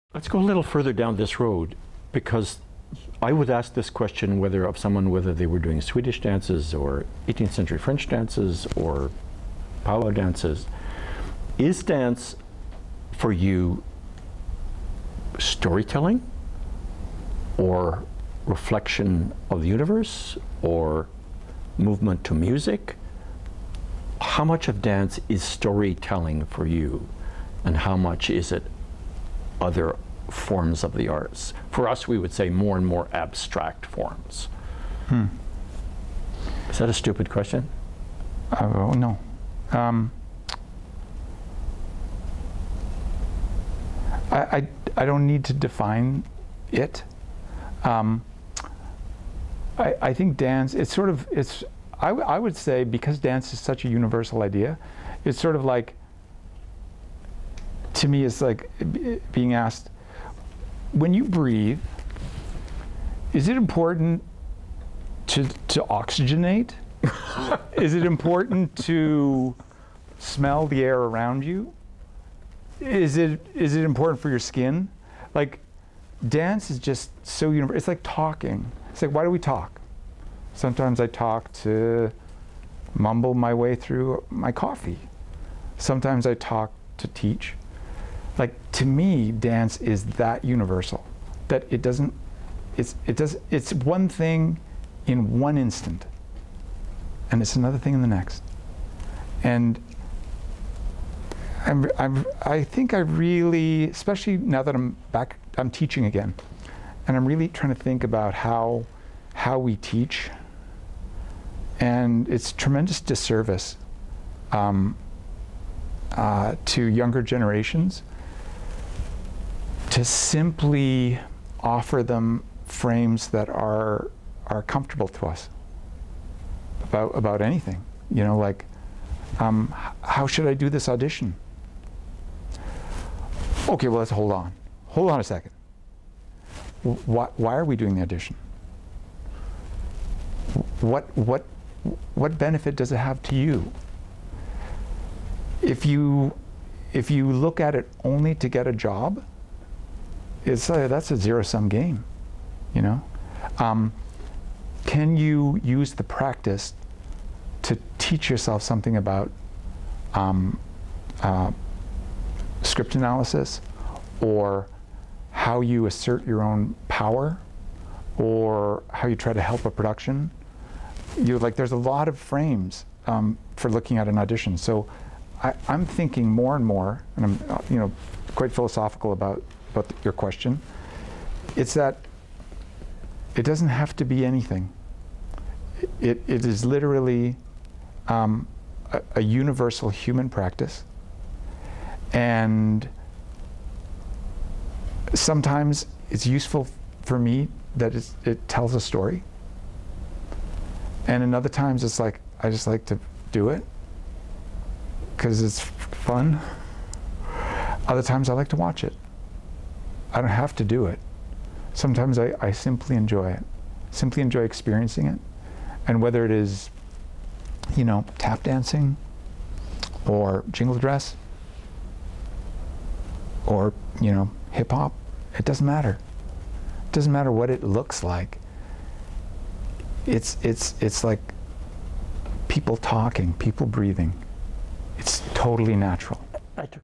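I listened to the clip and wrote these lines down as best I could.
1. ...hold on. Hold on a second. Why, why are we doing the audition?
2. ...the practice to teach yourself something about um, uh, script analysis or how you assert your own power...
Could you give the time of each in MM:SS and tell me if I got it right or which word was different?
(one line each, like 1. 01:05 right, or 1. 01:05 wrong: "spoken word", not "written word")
1. 02:14 right
2. 02:35 right.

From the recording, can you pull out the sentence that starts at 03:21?
And in other times it's like, I just like to do it because it's fun.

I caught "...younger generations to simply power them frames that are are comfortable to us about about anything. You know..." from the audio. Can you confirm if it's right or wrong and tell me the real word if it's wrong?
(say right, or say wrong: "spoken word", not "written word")
wrong: "offer", not "power".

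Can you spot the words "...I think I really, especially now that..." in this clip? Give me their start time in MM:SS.
01:42.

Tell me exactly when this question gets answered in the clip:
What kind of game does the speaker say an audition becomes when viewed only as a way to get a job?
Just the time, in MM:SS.
02:31.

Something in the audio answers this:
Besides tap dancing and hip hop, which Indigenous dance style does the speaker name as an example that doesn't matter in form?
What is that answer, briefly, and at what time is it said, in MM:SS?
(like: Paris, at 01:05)
Jingle dress, at 03:40.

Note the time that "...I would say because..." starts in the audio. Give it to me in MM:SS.
00:52.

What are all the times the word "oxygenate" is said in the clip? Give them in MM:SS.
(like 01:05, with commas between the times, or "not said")
01:05.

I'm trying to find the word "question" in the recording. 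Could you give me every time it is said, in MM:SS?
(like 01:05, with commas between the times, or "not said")
00:03, 00:37, 03:00.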